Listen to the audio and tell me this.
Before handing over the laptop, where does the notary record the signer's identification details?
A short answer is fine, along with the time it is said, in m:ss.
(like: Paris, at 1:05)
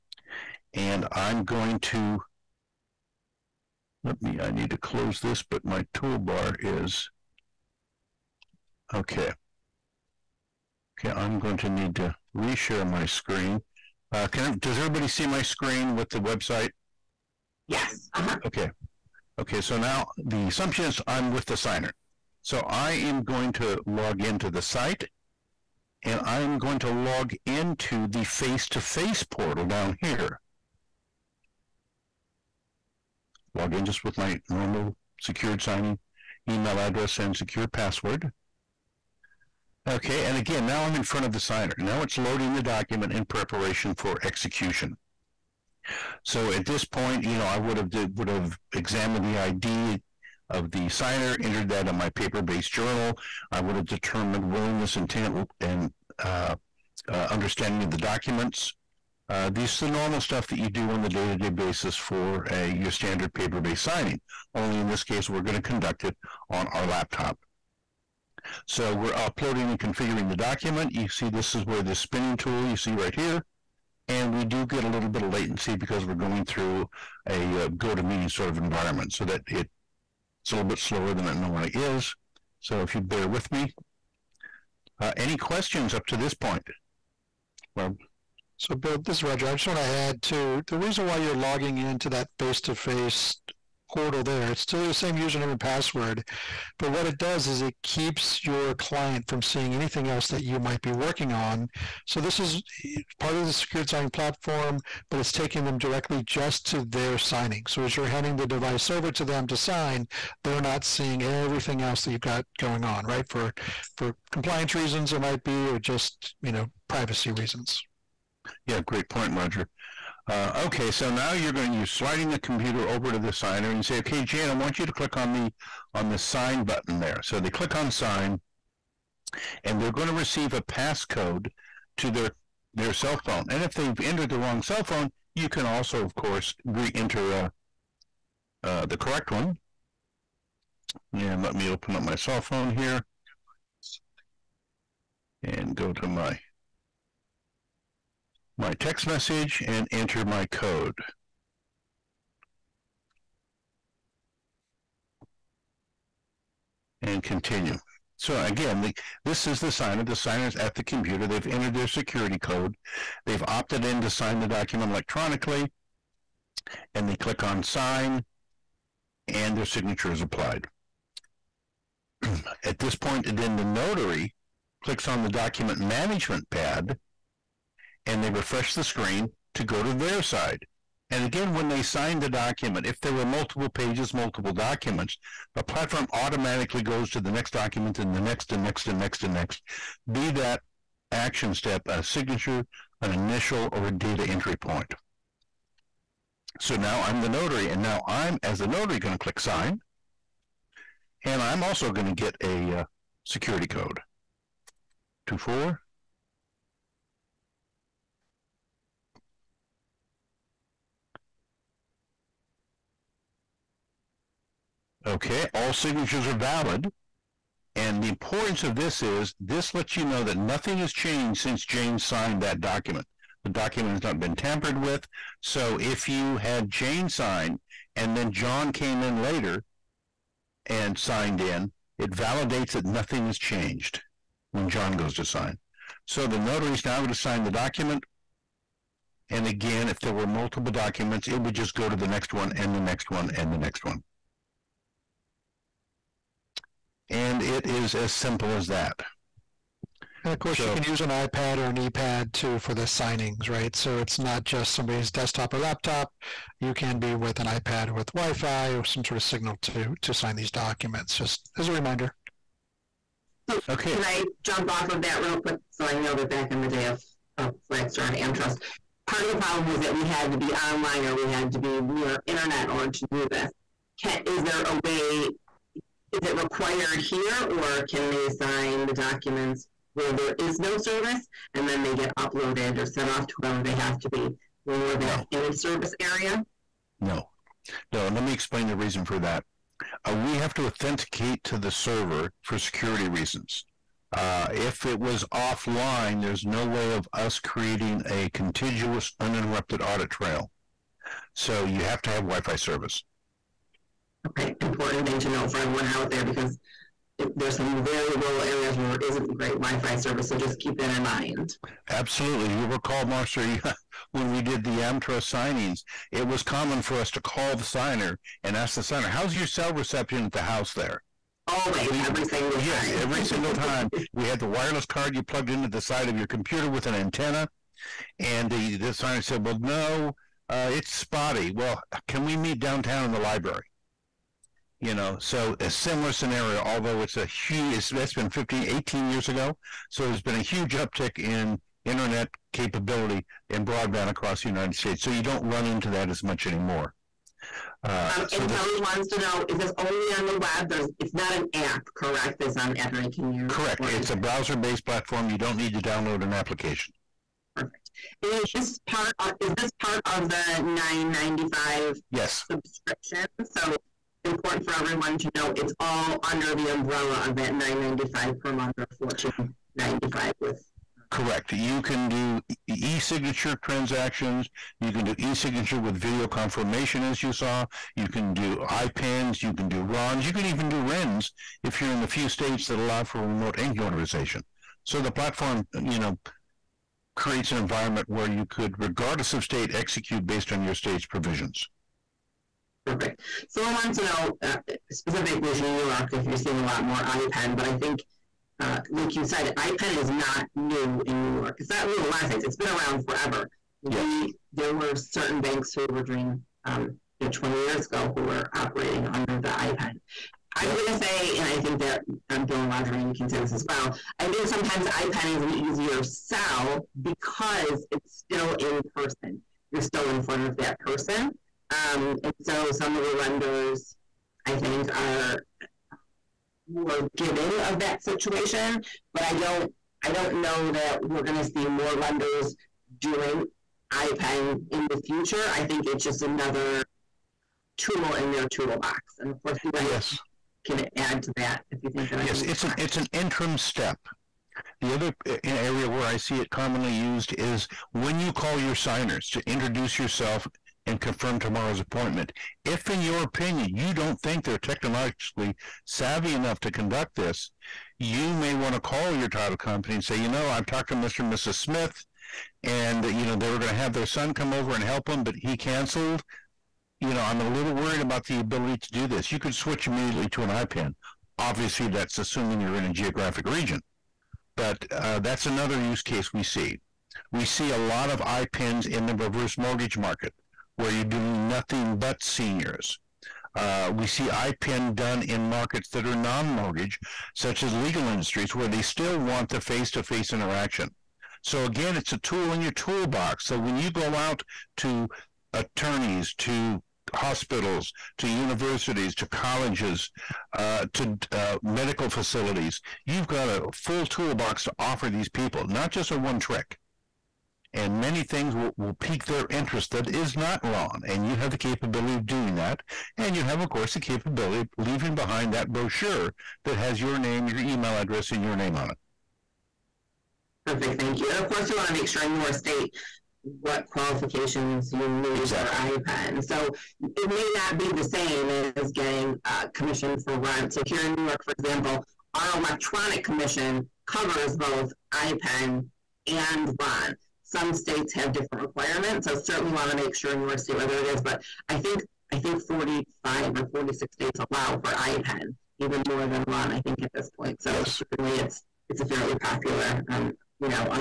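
Paper-based journal, at 0:52.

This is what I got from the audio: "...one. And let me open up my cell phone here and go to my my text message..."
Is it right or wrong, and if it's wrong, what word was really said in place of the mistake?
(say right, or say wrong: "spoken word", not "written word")
right.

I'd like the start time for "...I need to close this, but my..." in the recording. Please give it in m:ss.
0:04.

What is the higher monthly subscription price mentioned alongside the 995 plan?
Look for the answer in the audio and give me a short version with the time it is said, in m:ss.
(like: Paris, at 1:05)
1495, at 6:08.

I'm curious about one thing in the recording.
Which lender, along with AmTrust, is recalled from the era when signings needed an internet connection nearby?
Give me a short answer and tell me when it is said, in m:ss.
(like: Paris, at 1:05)
Flagstar, at 4:27.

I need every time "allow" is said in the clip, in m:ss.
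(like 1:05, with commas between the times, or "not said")
6:22, 9:04.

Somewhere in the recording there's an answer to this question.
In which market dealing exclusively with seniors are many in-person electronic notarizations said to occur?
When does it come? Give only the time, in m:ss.
7:59.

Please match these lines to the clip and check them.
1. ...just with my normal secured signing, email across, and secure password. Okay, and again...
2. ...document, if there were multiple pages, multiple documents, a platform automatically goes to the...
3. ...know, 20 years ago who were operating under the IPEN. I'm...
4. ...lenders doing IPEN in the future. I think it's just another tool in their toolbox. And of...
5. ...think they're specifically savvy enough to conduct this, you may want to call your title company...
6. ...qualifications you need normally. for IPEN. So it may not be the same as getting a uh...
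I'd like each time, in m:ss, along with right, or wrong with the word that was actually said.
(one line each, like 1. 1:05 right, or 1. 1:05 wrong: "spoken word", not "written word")
1. 0:33 wrong: "address", not "across"
2. 3:02 right
3. 6:47 right
4. 7:11 right
5. 7:34 wrong: "technologically", not "specifically"
6. 8:43 wrong: "exactly", not "normally".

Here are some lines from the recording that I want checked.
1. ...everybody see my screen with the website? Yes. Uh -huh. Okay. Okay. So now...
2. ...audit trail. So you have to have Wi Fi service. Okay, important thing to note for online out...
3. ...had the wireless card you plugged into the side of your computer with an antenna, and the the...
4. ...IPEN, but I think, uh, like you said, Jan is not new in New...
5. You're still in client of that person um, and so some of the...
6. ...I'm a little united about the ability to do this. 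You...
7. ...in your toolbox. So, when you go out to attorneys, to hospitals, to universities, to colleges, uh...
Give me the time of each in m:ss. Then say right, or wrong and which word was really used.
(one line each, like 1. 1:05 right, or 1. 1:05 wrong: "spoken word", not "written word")
1. 0:14 right
2. 4:59 wrong: "everyone", not "online"
3. 5:24 right
4. 6:37 wrong: "IPEN", not "Jan"
5. 6:59 wrong: "front", not "client"
6. 7:47 wrong: "worried", not "united"
7. 8:12 right.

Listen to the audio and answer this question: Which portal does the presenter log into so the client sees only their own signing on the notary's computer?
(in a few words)
Face-to-face portal.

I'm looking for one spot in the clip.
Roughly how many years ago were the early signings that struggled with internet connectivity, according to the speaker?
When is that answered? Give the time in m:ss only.
5:38.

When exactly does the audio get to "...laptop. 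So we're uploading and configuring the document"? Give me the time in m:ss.
1:06.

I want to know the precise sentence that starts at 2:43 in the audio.
They've opted in to sign the document electronically.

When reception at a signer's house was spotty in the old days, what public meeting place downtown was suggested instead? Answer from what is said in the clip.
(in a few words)
The library.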